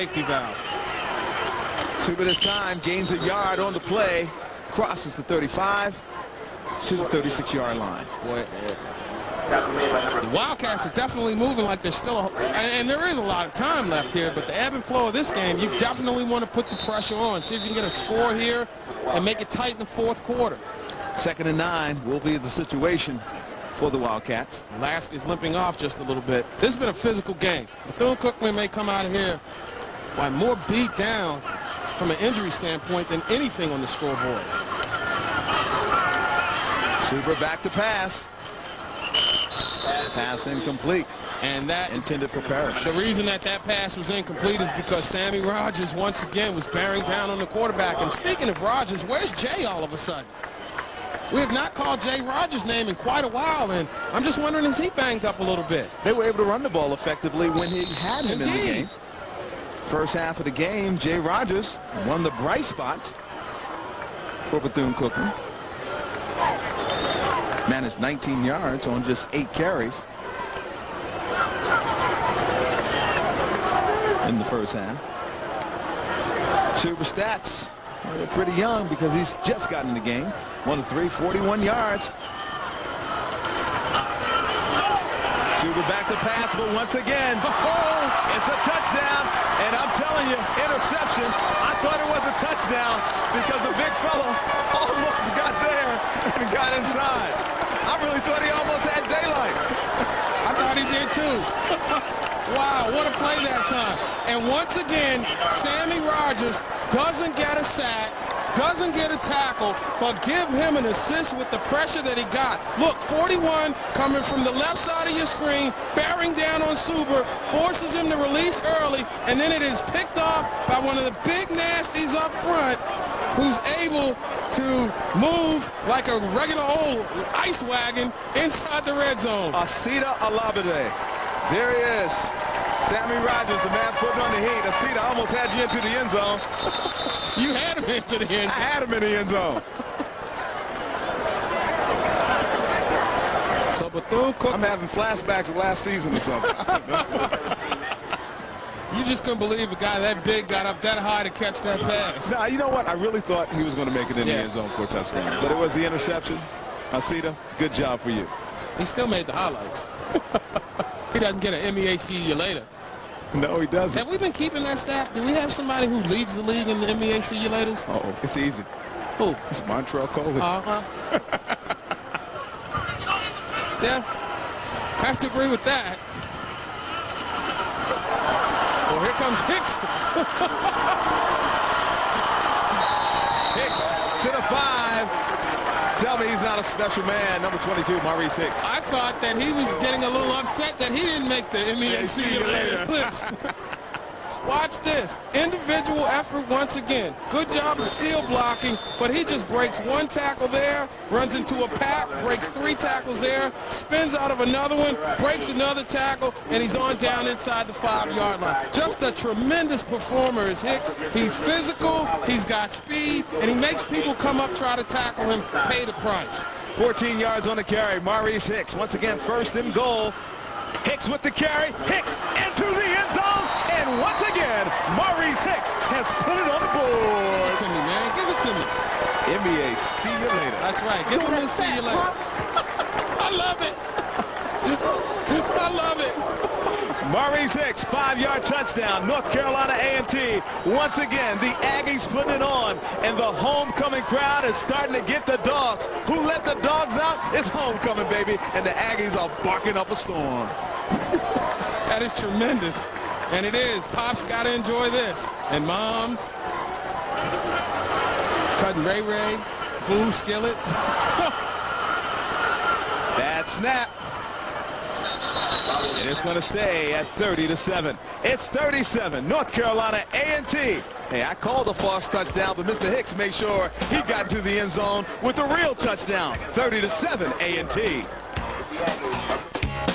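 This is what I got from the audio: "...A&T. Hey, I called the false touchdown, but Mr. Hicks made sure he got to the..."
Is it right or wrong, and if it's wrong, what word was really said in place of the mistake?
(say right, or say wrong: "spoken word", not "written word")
right.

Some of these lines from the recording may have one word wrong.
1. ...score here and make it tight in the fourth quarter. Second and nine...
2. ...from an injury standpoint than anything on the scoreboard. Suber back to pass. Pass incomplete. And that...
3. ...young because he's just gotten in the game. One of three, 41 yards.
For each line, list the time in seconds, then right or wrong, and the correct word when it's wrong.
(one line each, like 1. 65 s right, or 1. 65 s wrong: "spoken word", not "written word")
1. 17 s right
2. 31 s right
3. 78 s right.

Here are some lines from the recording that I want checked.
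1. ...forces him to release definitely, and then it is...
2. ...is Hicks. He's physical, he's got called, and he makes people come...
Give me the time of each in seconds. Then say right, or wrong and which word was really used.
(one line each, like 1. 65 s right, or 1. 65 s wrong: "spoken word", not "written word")
1. 117 s wrong: "early", not "definitely"
2. 210 s wrong: "speed", not "called".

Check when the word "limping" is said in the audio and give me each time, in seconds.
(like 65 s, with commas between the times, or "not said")
25 s.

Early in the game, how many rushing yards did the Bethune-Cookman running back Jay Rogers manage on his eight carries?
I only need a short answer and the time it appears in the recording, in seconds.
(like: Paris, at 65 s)
19, at 67 s.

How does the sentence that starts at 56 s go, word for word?
They were able to run the ball effectively when he had him Indeed.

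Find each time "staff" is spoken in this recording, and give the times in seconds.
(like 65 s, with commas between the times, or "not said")
164 s.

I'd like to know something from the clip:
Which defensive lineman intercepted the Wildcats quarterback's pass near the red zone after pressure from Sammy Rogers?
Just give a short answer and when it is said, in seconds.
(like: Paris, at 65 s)
Asita Alabade, at 129 s.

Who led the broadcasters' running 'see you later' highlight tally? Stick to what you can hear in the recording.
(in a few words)
Montreal Coley.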